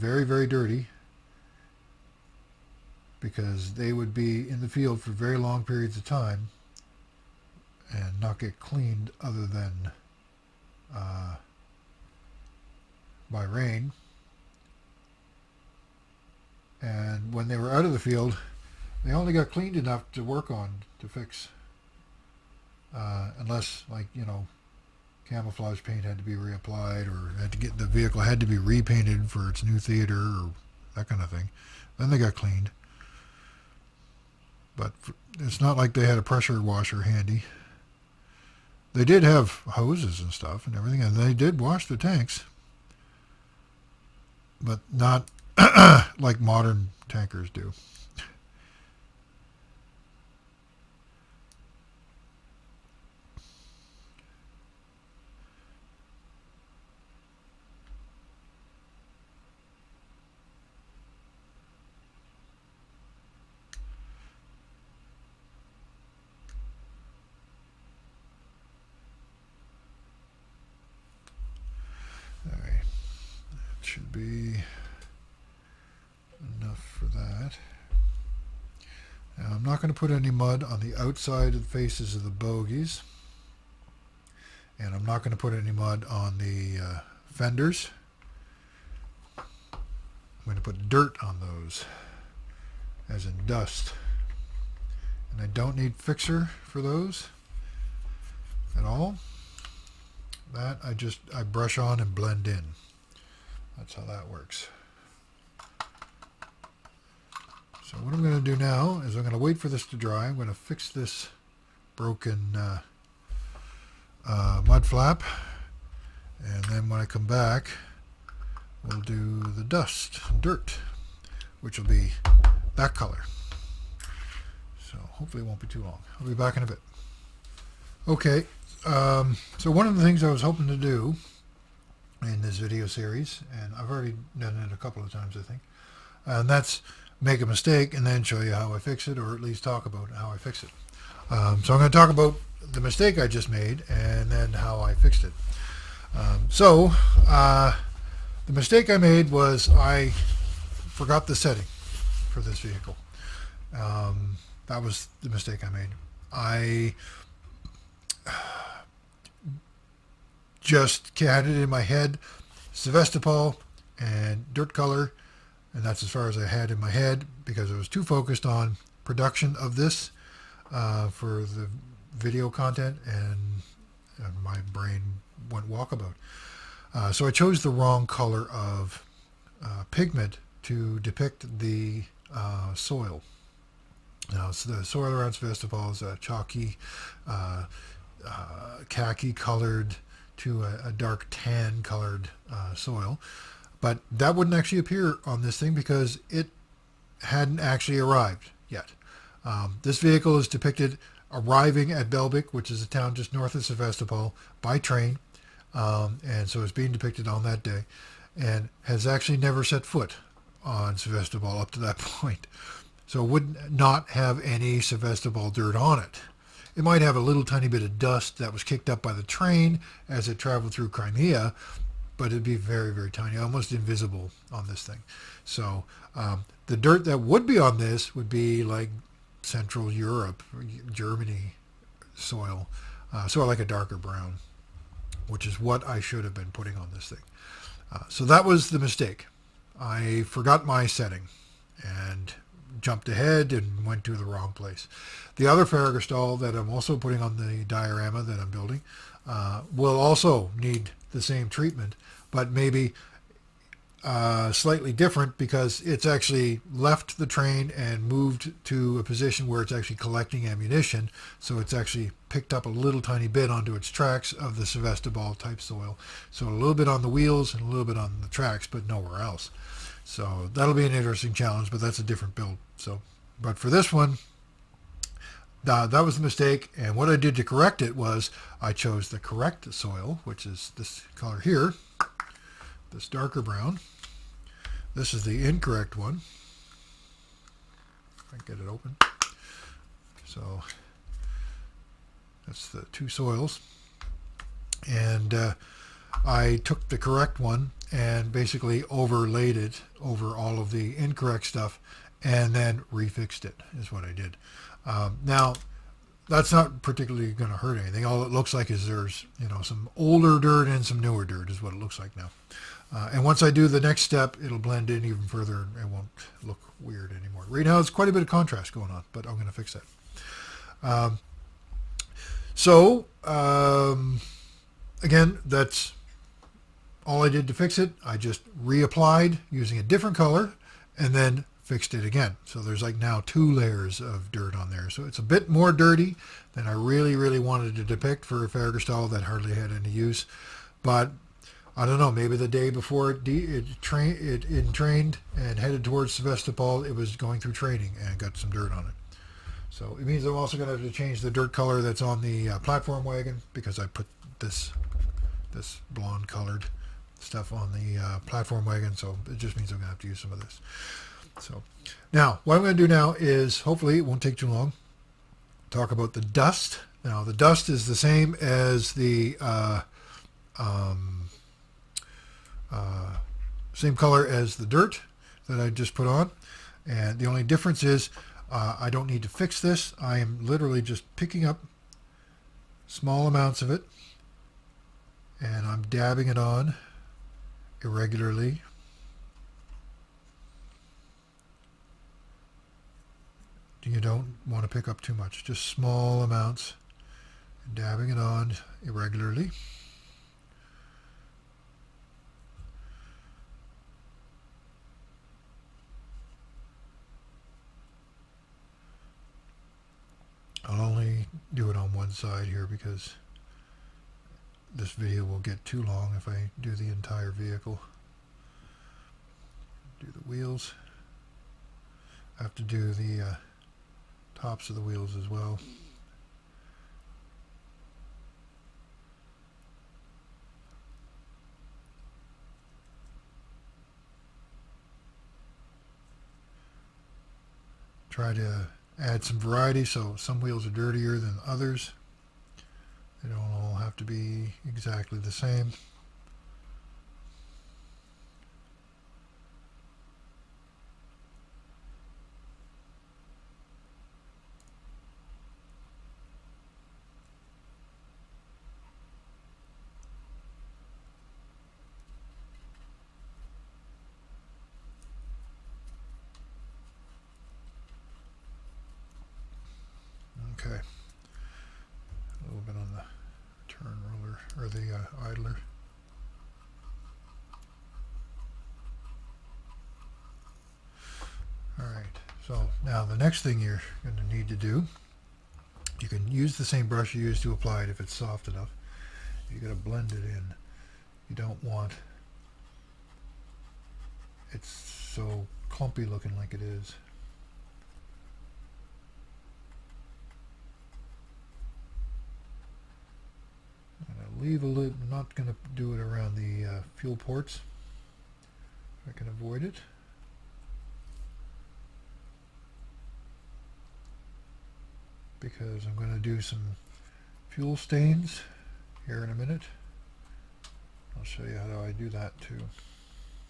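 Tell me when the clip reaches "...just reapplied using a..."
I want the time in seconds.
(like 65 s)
328 s.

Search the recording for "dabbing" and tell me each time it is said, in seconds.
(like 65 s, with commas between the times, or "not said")
385 s, 397 s.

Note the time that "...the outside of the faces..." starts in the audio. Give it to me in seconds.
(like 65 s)
80 s.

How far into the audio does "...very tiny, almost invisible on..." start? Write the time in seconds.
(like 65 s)
222 s.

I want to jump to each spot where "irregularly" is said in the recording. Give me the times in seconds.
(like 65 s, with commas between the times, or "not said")
387 s, 398 s.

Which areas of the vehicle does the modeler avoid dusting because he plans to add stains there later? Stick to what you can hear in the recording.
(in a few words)
fuel ports.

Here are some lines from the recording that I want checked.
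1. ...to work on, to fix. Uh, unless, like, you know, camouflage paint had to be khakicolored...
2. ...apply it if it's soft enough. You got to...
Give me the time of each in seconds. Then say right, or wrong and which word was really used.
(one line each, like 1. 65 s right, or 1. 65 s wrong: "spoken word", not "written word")
1. 20 s wrong: "reapplied", not "khakicolored"
2. 487 s right.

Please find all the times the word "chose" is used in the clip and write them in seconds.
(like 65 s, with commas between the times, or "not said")
177 s, 278 s.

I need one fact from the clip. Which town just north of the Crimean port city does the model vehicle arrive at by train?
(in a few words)
Belbek.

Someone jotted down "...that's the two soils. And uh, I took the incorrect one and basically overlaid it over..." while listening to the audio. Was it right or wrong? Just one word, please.
wrong.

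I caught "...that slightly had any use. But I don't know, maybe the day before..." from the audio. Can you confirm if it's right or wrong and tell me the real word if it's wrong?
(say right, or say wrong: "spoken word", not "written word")
wrong: "hardly", not "slightly".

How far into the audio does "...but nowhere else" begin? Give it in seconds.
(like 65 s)
268 s.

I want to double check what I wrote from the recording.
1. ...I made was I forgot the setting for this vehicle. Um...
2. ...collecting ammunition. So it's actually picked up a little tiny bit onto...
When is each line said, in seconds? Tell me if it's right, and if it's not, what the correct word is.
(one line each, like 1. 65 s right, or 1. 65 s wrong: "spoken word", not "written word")
1. 148 s right
2. 259 s right.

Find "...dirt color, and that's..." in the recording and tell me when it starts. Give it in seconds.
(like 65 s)
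164 s.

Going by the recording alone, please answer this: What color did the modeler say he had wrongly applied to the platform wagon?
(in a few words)
blonde.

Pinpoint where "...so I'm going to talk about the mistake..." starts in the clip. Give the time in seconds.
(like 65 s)
141 s.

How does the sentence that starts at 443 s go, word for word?
They don't all have to be exactly the same.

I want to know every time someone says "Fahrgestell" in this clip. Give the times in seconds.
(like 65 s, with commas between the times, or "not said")
245 s, 338 s.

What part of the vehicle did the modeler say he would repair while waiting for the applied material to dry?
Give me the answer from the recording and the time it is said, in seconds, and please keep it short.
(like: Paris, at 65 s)
mud flap, at 114 s.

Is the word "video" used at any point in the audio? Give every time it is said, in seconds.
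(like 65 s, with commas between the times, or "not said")
132 s, 172 s, 414 s.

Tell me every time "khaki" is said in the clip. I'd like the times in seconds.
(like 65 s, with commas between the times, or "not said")
188 s.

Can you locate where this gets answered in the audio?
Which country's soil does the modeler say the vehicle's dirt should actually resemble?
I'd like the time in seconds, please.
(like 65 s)
230 s.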